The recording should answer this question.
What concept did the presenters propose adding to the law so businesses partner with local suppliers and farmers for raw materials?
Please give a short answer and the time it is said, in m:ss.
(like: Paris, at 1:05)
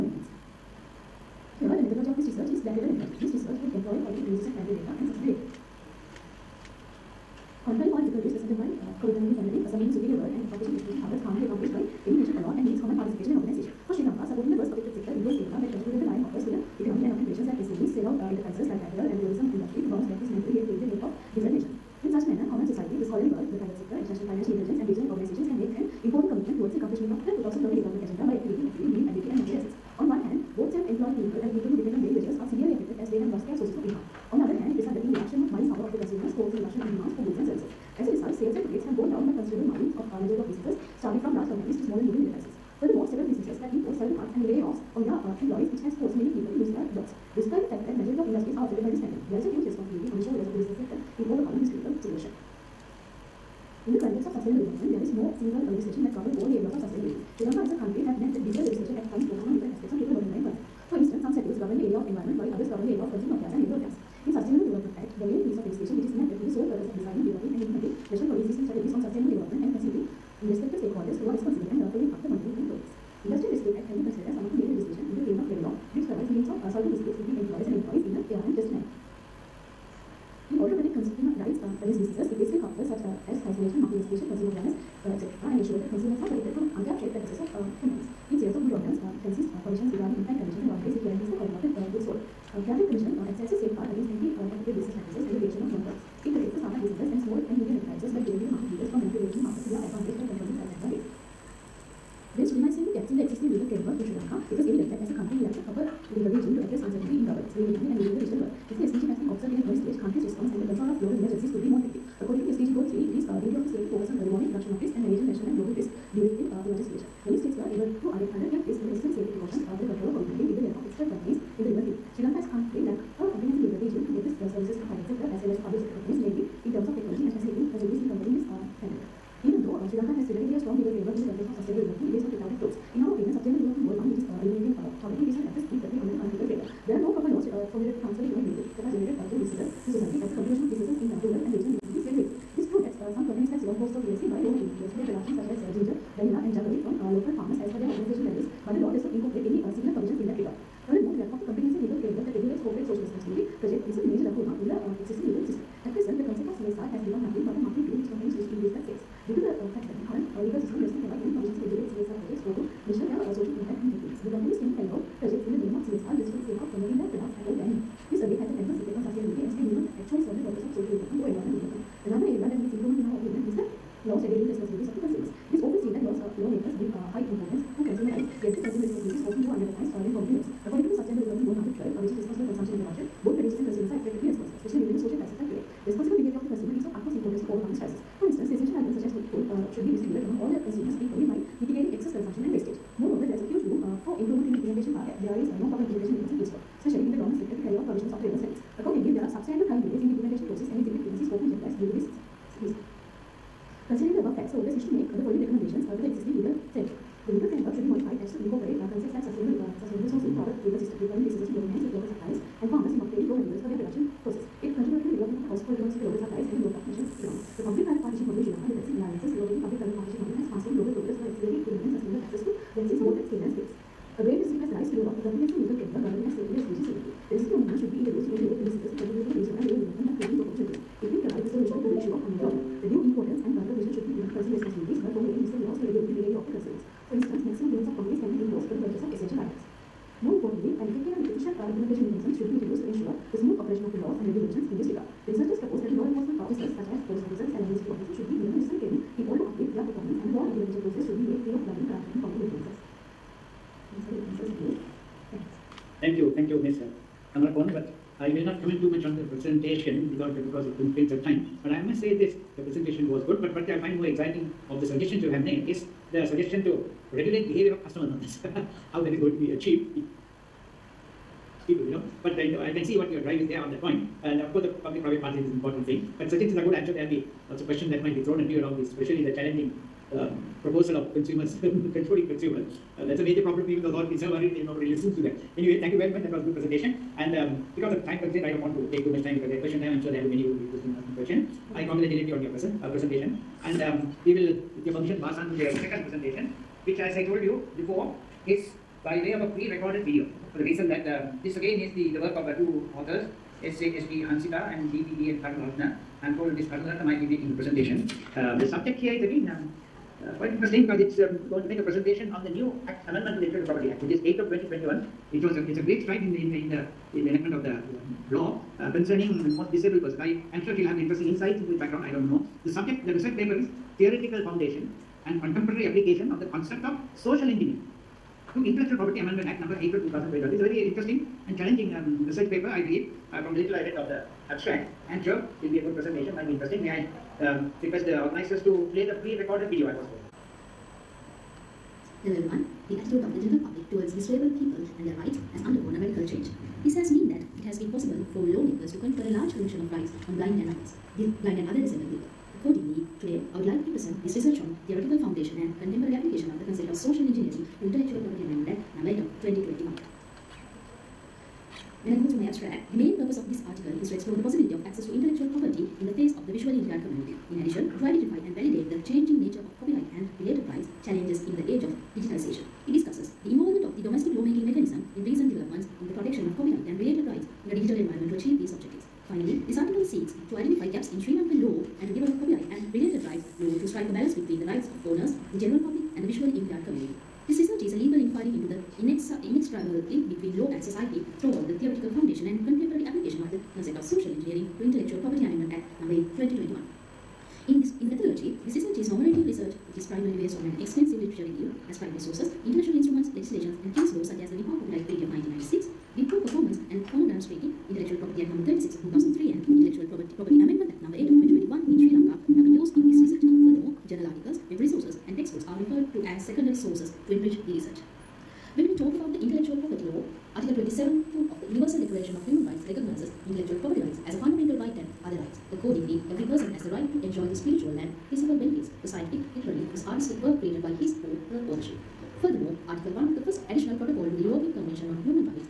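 sustainable sourcing, at 3:29.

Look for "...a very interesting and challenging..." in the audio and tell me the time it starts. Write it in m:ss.
5:30.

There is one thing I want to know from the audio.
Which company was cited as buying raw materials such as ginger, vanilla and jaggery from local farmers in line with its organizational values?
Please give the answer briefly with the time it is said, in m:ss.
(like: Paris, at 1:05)
Ceylon Cold Stores PLC, at 2:23.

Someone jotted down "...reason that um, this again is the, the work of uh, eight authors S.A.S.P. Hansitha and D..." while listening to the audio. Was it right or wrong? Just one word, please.
wrong.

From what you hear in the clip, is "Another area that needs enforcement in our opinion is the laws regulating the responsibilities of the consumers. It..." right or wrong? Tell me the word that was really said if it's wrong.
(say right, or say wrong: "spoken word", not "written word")
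wrong: "improvement", not "enforcement".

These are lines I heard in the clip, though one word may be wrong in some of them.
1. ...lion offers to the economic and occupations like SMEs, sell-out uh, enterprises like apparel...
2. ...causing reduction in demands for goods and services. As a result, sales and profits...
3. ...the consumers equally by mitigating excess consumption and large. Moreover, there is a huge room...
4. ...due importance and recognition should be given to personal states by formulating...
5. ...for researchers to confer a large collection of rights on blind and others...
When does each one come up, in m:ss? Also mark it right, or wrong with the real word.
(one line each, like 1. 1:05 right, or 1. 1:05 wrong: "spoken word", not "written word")
1. 0:16 right
2. 0:36 right
3. 3:10 wrong: "wastage", not "large"
4. 3:52 wrong: "responsibilities", not "states"
5. 5:48 wrong: "lawmakers", not "researchers".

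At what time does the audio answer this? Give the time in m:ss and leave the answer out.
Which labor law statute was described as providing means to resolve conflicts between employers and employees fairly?
1:13.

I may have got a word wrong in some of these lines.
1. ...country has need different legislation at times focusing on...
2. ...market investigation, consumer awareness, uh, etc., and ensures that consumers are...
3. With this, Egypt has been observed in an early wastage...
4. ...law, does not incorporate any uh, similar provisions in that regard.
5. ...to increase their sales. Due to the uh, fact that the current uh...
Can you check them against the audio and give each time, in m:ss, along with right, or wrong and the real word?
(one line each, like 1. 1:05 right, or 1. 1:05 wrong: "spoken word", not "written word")
1. 0:57 right
2. 1:23 right
3. 1:48 wrong: "stage", not "wastage"
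4. 2:28 right
5. 2:38 right.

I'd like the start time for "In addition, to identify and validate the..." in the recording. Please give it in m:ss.
6:07.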